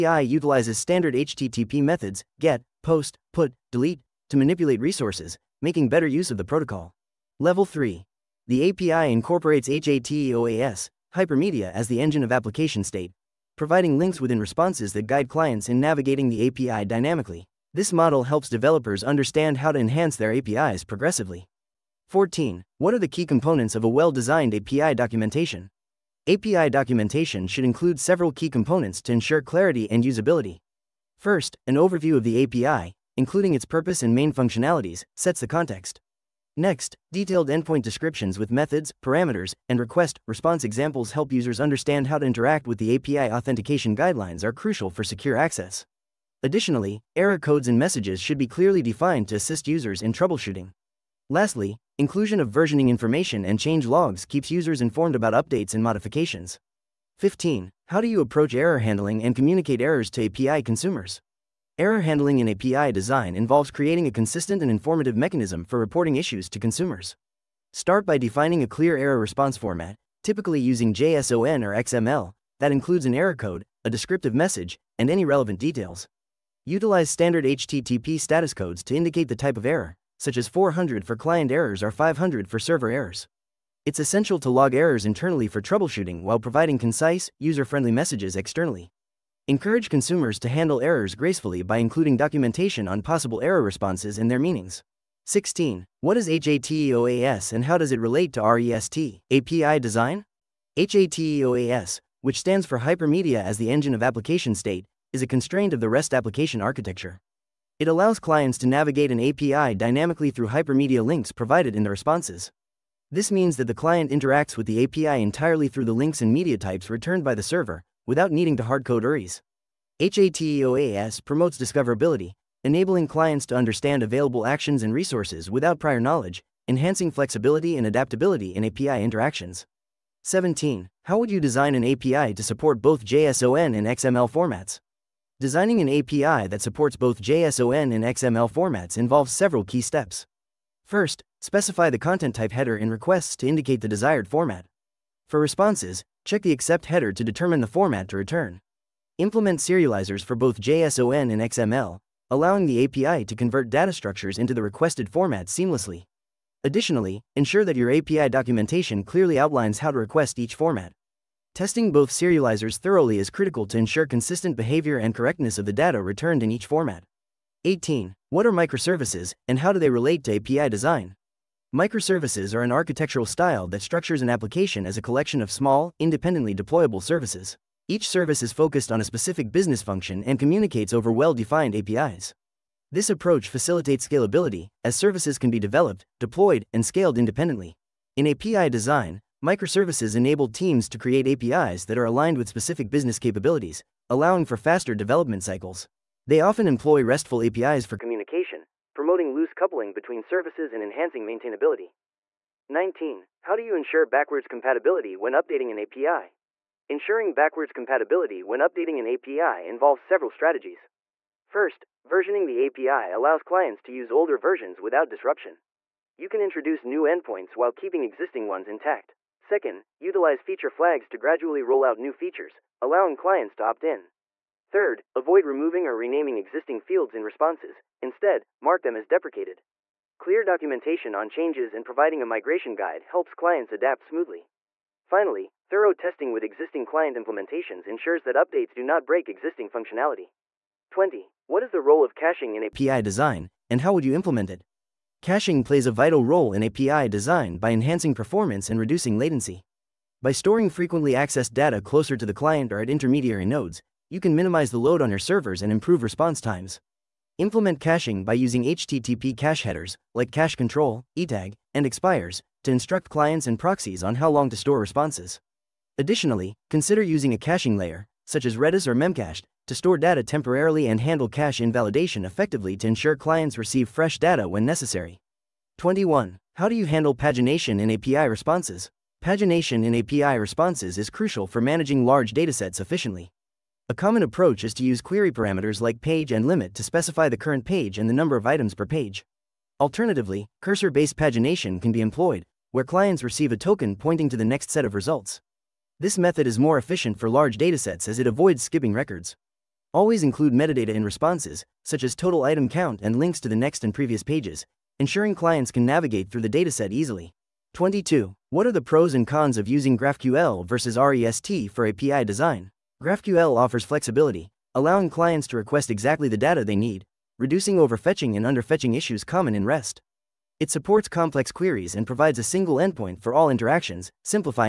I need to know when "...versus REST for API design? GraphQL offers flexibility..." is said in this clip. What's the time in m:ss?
5:10.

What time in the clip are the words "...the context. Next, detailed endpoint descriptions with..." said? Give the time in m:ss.
0:35.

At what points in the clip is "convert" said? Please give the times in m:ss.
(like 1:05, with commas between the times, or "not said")
2:33.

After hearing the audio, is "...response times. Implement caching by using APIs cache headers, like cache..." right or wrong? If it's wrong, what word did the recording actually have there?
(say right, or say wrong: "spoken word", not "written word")
wrong: "HTTP", not "APIs".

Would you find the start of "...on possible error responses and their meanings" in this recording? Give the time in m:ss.
1:32.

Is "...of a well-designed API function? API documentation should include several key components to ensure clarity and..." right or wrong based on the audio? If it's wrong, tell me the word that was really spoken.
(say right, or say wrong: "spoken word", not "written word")
wrong: "documentation", not "function".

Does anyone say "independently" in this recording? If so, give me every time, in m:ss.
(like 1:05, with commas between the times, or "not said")
2:55, 3:07.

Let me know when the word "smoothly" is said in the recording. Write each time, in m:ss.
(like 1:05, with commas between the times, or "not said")
3:54.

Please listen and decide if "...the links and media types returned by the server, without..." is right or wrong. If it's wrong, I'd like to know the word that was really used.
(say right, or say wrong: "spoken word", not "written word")
right.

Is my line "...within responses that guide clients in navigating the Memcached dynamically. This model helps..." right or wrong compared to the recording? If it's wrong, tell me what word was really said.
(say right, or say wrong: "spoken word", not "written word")
wrong: "API", not "Memcached".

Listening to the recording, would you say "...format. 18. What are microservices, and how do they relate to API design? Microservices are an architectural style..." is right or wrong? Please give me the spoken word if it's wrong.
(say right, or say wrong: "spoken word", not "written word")
right.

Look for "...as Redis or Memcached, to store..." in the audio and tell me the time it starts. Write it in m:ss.
4:28.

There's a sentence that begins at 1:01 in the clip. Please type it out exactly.
Error handling in API design involves creating a consistent and informative mechanism for reporting issues to consumers.